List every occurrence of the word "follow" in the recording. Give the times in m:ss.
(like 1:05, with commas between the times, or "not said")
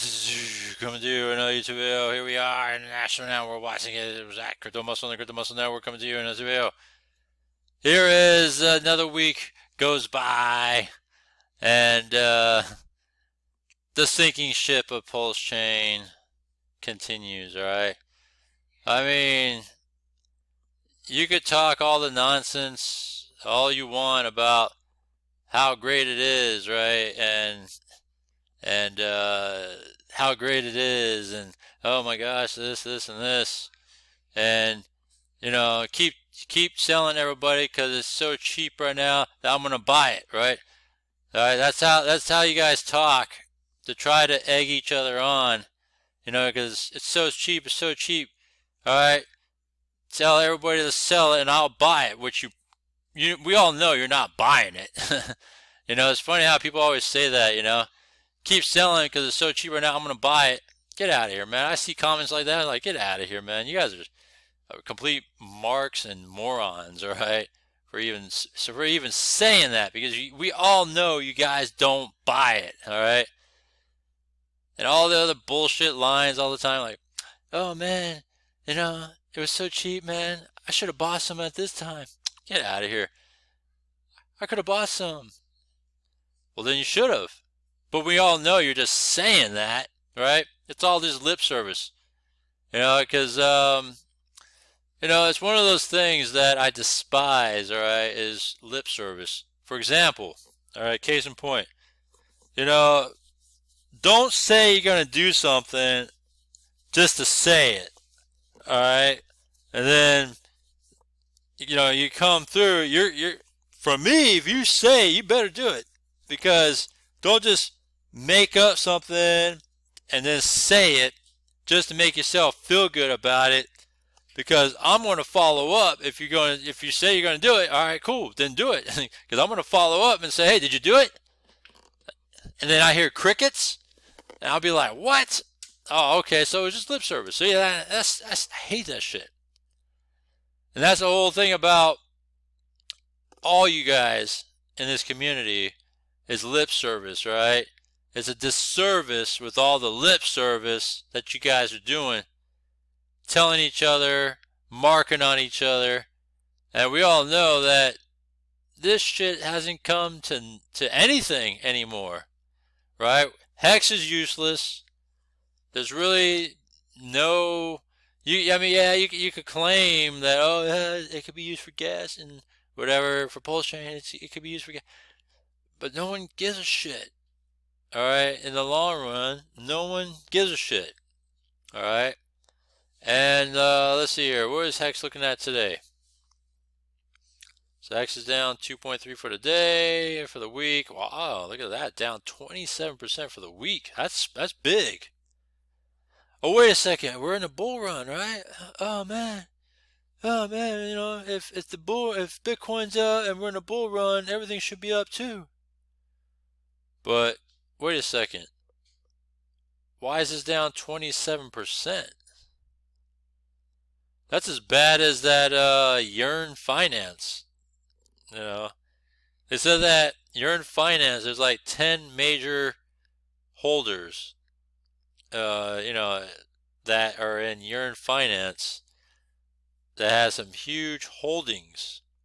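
2:05, 2:09.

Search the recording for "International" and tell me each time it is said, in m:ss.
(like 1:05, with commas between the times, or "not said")
0:02.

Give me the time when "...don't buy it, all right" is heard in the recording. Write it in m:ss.
1:11.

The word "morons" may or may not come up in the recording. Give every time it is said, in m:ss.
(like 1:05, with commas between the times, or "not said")
1:06.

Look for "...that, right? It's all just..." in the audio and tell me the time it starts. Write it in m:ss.
1:29.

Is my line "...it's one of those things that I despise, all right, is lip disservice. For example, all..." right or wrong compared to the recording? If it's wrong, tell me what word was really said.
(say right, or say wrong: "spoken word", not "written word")
wrong: "service", not "disservice".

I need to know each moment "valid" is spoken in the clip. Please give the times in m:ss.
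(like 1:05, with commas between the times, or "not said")
not said.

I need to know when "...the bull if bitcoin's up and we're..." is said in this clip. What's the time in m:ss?
3:21.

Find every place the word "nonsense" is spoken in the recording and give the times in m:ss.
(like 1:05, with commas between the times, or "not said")
0:22.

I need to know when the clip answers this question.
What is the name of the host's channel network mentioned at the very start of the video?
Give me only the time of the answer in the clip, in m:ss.
0:05.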